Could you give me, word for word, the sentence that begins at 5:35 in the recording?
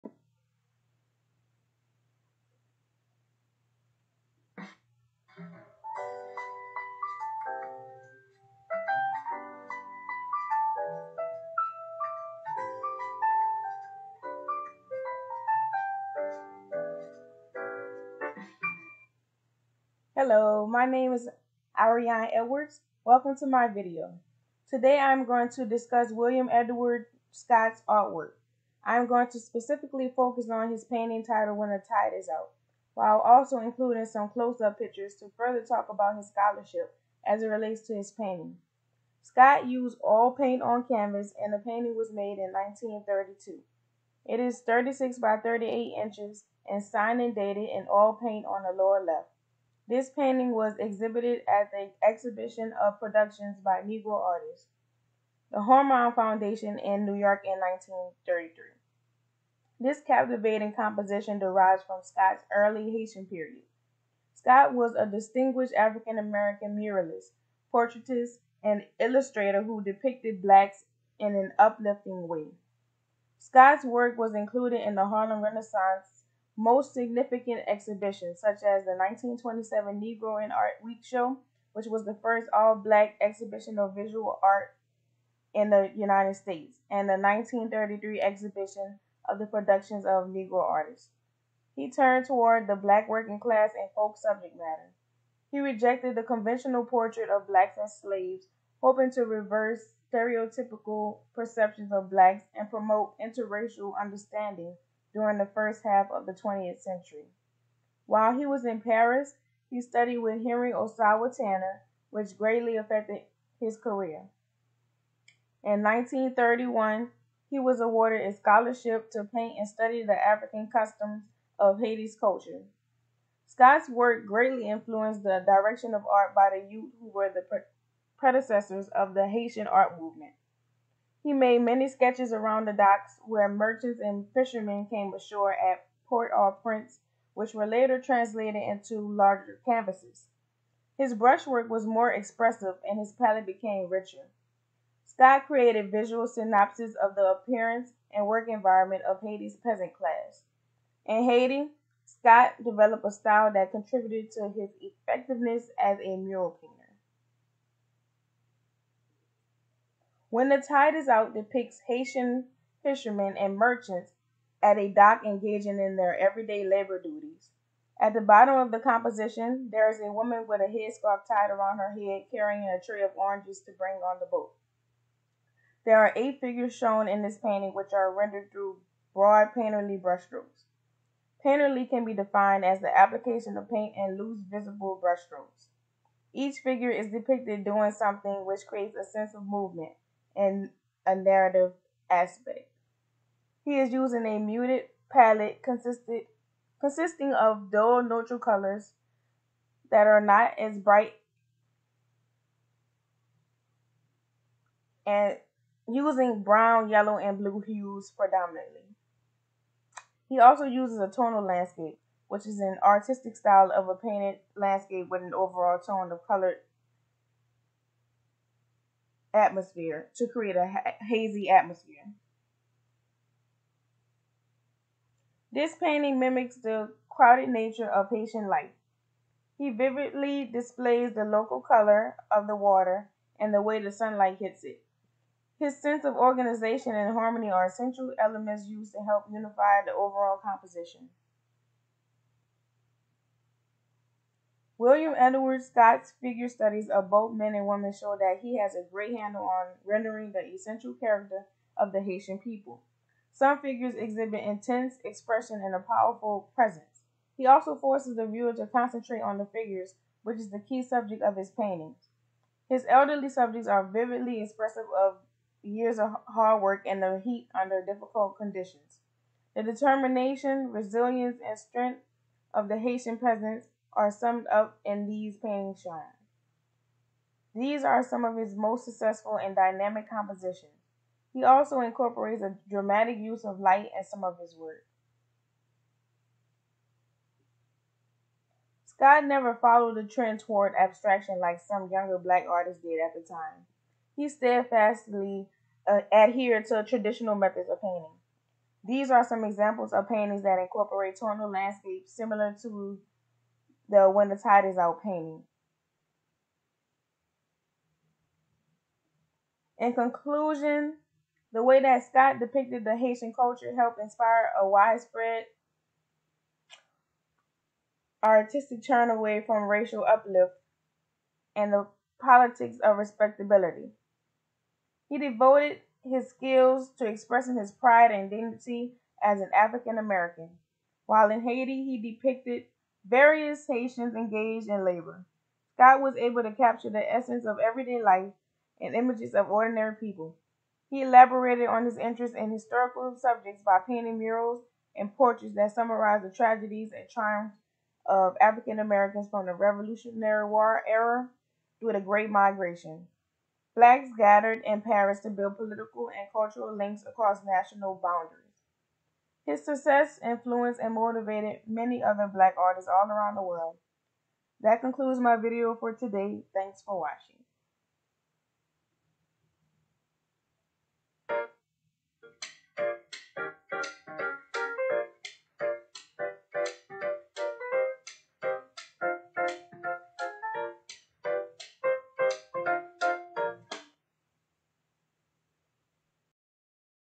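Scott was able to capture the essence of everyday life and images of ordinary people.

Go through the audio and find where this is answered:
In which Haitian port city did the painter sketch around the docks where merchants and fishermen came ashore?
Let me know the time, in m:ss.
2:16.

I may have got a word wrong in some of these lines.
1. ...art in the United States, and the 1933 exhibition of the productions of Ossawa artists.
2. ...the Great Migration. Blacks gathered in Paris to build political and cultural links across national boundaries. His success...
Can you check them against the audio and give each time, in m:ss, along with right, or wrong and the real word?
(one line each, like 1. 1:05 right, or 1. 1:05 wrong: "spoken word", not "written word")
1. 1:24 wrong: "Negro", not "Ossawa"
2. 5:51 right.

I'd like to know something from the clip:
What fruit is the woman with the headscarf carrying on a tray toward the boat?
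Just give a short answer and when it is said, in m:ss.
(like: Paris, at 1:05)
Oranges, at 2:53.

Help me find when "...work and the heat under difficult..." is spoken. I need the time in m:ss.
4:26.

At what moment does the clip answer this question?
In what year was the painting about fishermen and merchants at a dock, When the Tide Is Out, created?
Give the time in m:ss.
0:42.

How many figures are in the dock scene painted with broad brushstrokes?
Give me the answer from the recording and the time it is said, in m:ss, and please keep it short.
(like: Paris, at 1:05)
8, at 2:56.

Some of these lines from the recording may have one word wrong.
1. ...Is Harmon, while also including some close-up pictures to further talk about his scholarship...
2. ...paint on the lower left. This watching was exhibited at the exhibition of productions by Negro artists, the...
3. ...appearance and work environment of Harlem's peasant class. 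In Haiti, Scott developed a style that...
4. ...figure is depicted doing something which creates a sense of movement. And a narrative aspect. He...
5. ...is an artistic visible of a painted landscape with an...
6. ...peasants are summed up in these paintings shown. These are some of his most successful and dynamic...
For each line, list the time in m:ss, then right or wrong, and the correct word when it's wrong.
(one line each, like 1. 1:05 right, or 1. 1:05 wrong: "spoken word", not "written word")
1. 0:32 wrong: "Out", not "Harmon"
2. 0:48 wrong: "painting", not "watching"
3. 2:27 wrong: "Haiti", not "Harlem"
4. 3:06 right
5. 3:32 wrong: "style", not "visible"
6. 4:33 right.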